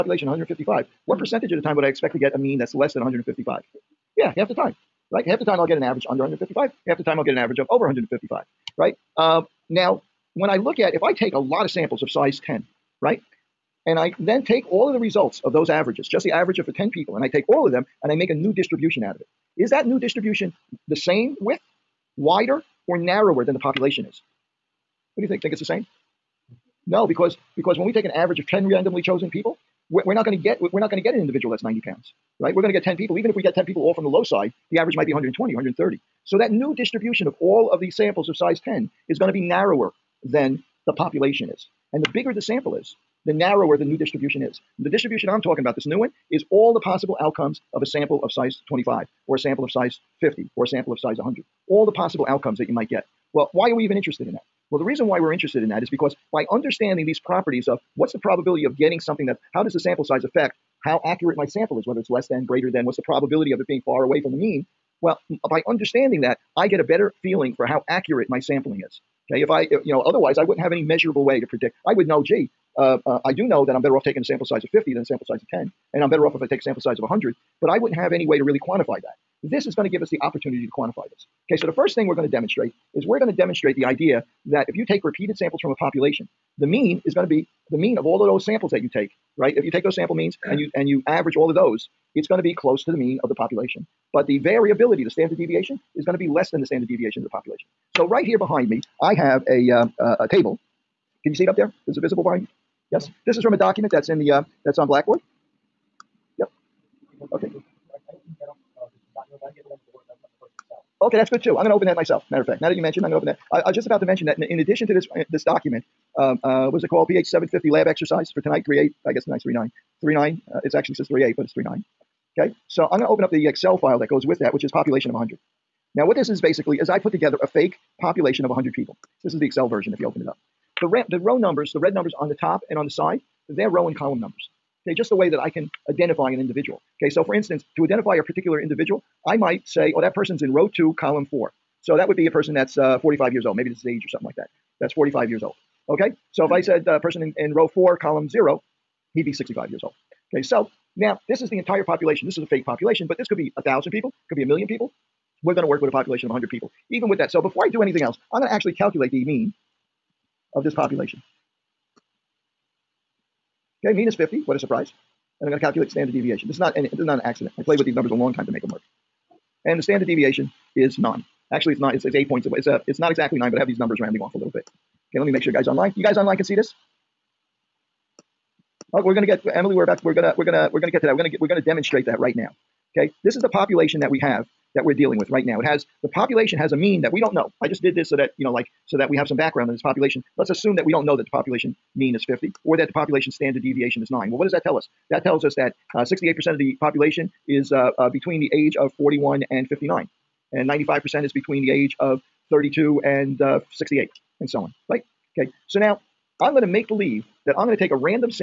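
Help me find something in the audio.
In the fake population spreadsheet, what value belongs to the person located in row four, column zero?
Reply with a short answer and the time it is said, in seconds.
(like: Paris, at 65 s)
65, at 149 s.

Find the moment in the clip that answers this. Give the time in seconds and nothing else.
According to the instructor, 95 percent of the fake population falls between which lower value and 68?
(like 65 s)
202 s.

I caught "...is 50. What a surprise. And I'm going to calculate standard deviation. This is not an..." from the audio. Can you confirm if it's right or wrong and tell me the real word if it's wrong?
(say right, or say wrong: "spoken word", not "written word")
right.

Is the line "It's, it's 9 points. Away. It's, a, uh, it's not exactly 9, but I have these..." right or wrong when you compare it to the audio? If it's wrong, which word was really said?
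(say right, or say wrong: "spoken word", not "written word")
wrong: "8", not "9".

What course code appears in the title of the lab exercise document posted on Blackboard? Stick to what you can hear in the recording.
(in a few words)
PH 750.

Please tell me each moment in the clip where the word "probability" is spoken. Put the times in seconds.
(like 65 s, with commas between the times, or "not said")
58 s, 63 s.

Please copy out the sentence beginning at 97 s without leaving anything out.
So right here behind me, I have a, uh, uh, a table.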